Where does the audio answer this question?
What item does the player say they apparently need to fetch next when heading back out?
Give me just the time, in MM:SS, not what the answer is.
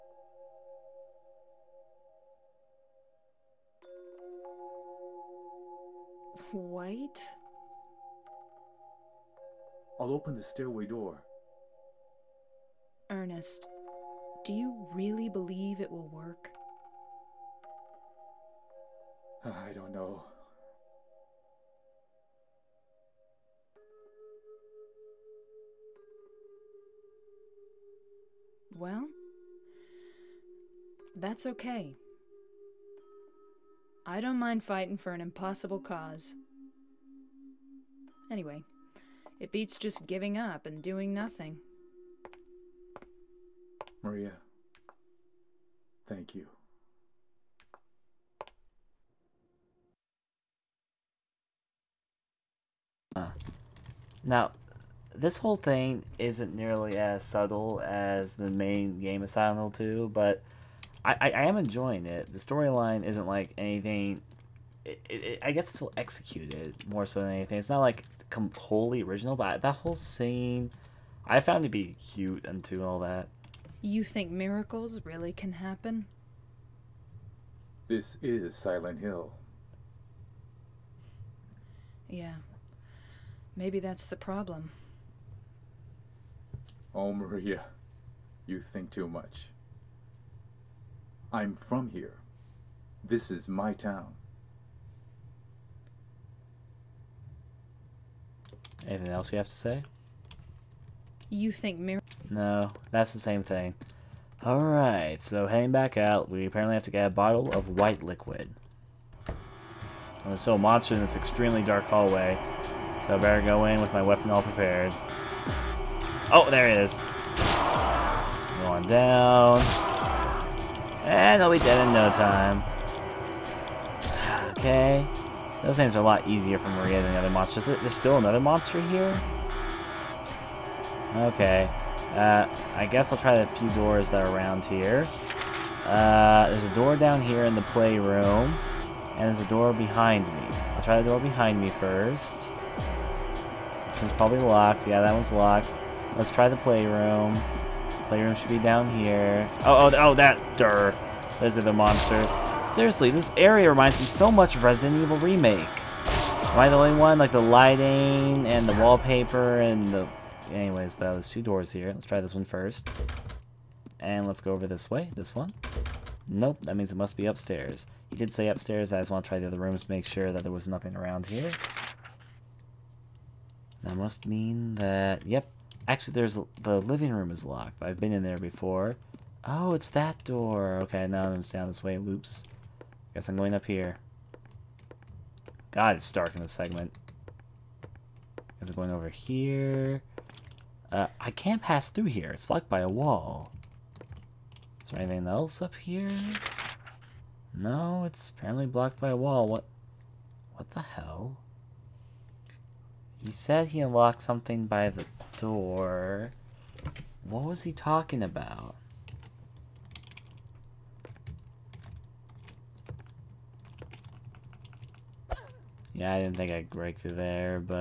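01:47.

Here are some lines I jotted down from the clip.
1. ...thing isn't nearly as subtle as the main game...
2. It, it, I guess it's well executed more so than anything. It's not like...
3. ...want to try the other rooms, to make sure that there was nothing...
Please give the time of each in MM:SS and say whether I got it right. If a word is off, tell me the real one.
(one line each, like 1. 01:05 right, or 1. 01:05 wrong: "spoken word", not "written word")
1. 00:55 right
2. 01:04 right
3. 02:49 right.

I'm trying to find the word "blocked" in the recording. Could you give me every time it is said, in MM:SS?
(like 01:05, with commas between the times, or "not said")
03:12, 03:18.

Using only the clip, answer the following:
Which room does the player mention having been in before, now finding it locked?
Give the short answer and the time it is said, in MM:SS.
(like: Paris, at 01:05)
living room, at 02:56.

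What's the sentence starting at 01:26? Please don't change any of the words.
Oh, Maria, you think too much.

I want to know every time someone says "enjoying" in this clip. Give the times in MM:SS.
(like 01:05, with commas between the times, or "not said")
01:01.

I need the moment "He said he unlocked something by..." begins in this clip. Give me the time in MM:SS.
03:23.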